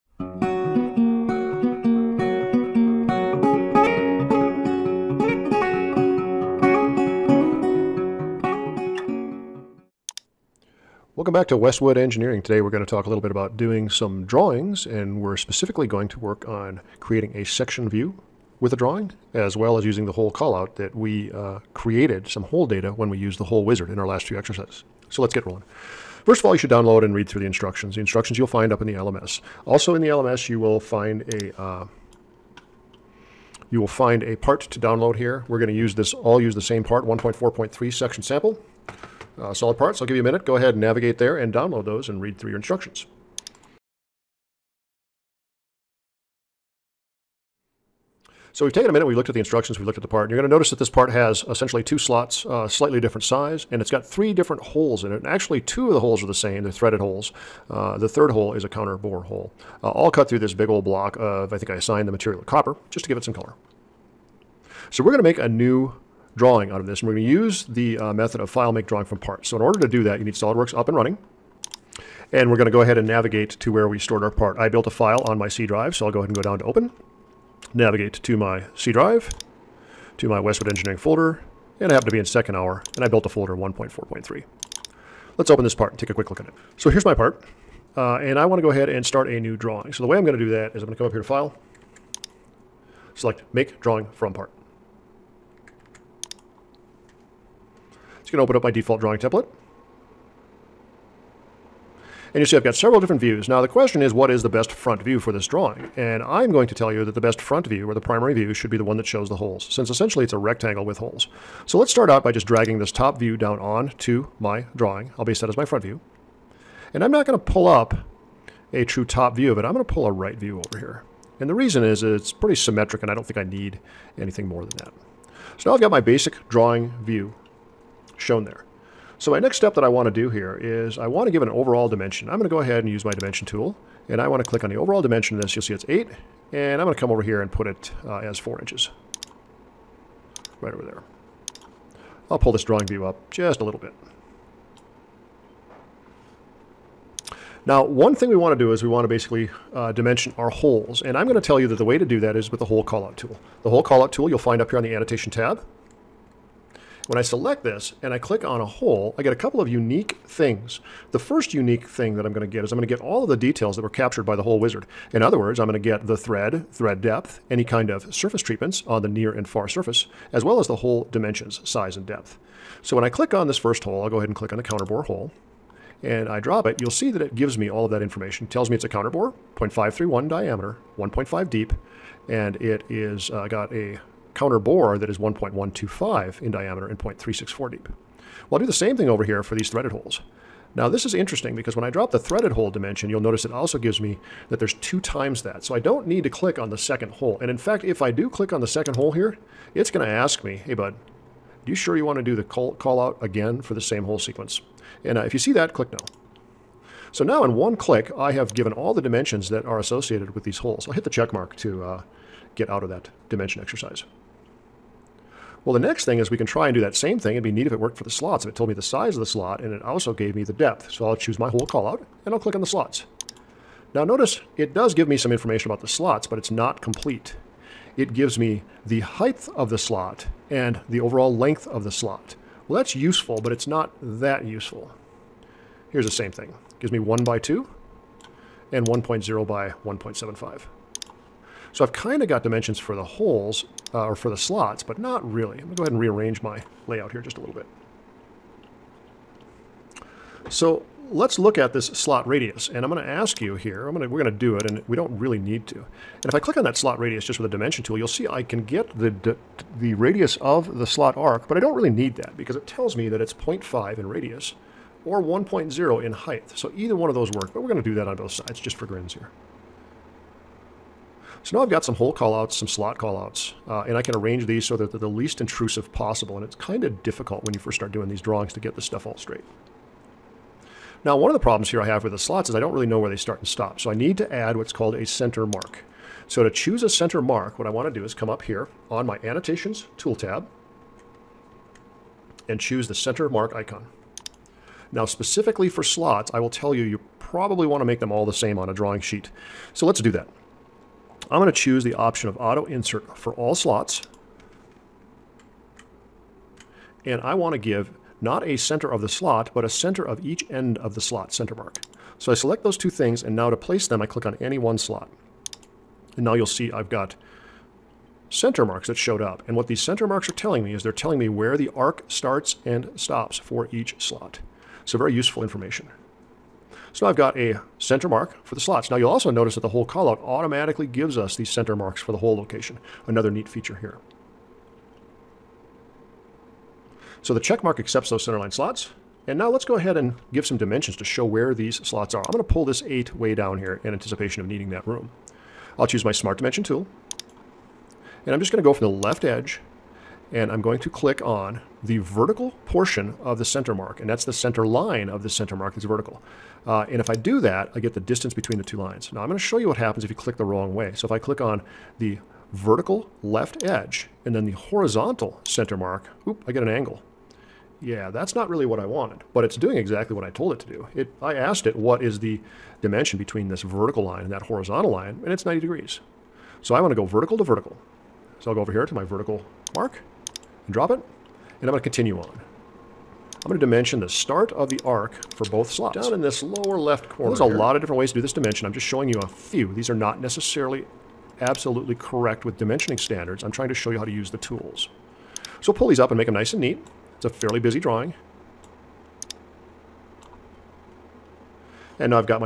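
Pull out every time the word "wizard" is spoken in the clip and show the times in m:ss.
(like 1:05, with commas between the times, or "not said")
0:23, 2:44.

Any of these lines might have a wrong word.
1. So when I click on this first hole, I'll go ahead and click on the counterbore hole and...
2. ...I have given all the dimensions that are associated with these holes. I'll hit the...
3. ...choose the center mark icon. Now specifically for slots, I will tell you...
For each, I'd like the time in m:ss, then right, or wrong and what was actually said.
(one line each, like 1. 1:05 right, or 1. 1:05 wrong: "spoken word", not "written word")
1. 2:52 right
2. 3:28 right
3. 4:52 right.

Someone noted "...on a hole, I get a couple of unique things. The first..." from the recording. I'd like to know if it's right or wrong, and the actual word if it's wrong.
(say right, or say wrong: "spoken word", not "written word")
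right.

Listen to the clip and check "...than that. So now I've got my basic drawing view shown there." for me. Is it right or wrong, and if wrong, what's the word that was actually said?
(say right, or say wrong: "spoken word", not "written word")
right.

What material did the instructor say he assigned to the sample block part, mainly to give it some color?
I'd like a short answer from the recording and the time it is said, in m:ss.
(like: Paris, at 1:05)
copper, at 1:02.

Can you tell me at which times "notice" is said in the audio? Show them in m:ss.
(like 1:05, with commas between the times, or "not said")
0:50, 3:13, 3:44, 5:29.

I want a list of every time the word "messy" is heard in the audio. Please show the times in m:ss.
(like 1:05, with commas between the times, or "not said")
not said.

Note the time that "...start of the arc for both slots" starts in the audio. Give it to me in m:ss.
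6:24.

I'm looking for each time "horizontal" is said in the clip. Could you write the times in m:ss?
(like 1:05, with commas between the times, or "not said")
6:04, 6:14.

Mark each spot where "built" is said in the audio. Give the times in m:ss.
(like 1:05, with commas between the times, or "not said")
1:14, 1:23.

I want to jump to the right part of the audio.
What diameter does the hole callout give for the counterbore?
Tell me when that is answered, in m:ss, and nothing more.
3:05.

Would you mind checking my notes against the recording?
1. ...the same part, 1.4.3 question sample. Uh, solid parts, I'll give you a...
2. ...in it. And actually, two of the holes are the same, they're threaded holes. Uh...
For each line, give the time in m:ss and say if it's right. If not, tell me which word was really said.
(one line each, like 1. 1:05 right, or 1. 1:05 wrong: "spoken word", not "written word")
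1. 0:36 wrong: "section", not "question"
2. 0:55 right.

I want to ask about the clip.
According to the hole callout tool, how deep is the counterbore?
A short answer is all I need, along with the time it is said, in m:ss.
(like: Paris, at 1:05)
0.364, at 3:06.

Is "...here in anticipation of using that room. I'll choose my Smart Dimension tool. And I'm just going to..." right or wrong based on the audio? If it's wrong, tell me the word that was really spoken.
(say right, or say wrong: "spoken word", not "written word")
wrong: "needing", not "using".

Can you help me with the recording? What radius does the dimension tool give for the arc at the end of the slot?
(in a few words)
0.5.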